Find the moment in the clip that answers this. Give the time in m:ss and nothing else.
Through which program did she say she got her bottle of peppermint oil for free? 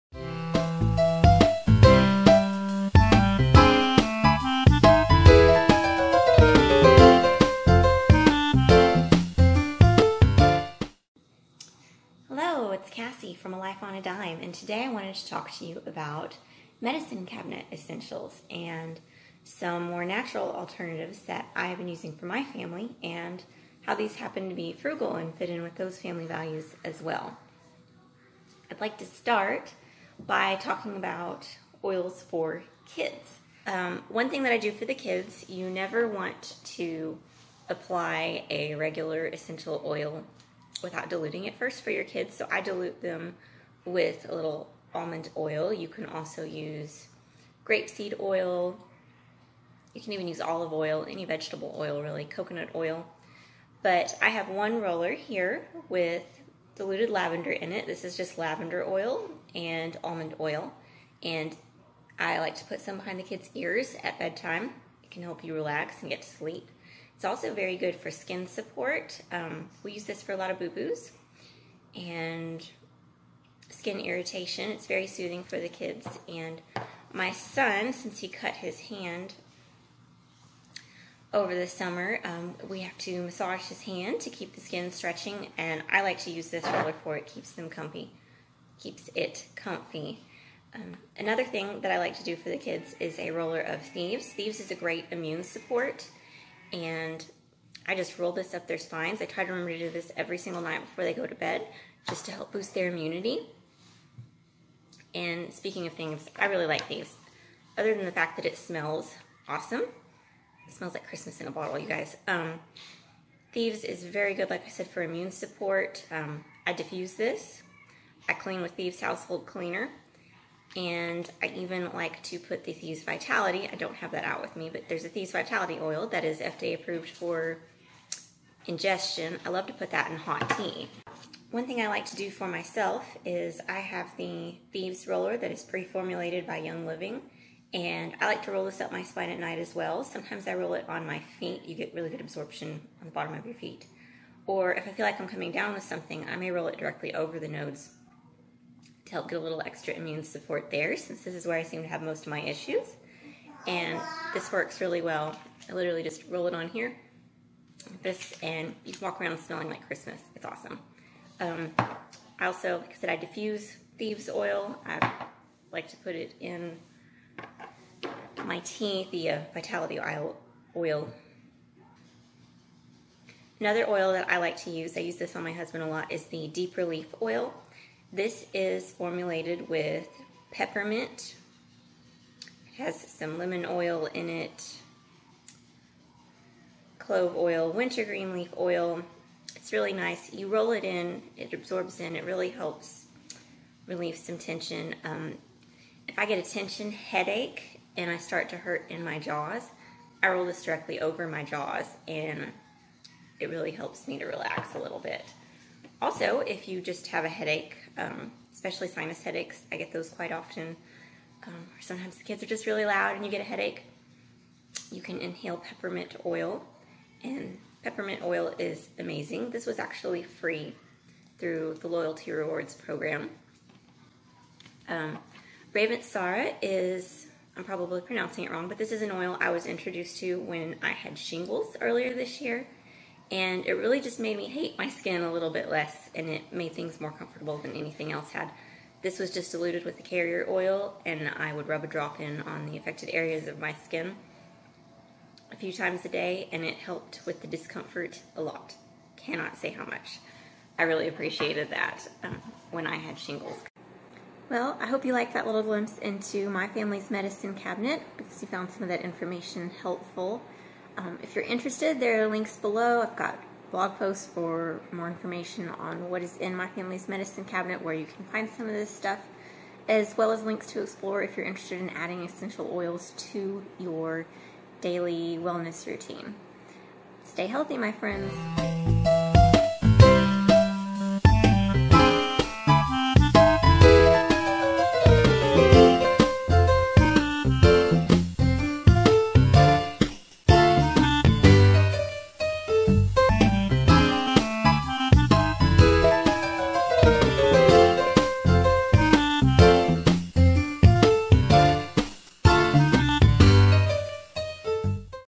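3:41.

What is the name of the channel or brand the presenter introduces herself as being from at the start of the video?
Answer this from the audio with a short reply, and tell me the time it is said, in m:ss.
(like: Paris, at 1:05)
A Life on a Dime, at 0:13.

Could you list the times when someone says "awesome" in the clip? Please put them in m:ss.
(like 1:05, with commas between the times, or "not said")
1:49, 2:40.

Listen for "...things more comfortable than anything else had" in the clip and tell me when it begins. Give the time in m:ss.
3:56.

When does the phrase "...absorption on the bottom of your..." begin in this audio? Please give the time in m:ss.
2:22.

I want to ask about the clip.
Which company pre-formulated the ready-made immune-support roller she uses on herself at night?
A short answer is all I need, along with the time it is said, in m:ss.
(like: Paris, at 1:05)
Young Living, at 2:16.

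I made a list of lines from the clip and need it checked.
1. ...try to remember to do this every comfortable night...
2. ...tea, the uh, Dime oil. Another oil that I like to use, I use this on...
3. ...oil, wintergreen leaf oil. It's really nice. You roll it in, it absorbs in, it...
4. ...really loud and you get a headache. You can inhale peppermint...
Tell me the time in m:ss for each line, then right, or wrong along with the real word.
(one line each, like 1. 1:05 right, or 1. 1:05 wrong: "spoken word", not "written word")
1. 1:39 wrong: "single", not "comfortable"
2. 2:48 wrong: "Vitality", not "Dime"
3. 3:07 right
4. 3:32 right.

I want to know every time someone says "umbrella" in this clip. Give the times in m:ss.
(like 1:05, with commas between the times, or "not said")
not said.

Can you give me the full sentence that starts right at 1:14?
It's very soothing for the kids.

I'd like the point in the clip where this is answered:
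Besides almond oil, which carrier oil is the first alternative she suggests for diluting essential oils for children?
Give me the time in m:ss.
0:47.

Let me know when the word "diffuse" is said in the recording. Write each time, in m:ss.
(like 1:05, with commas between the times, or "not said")
1:56, 2:43.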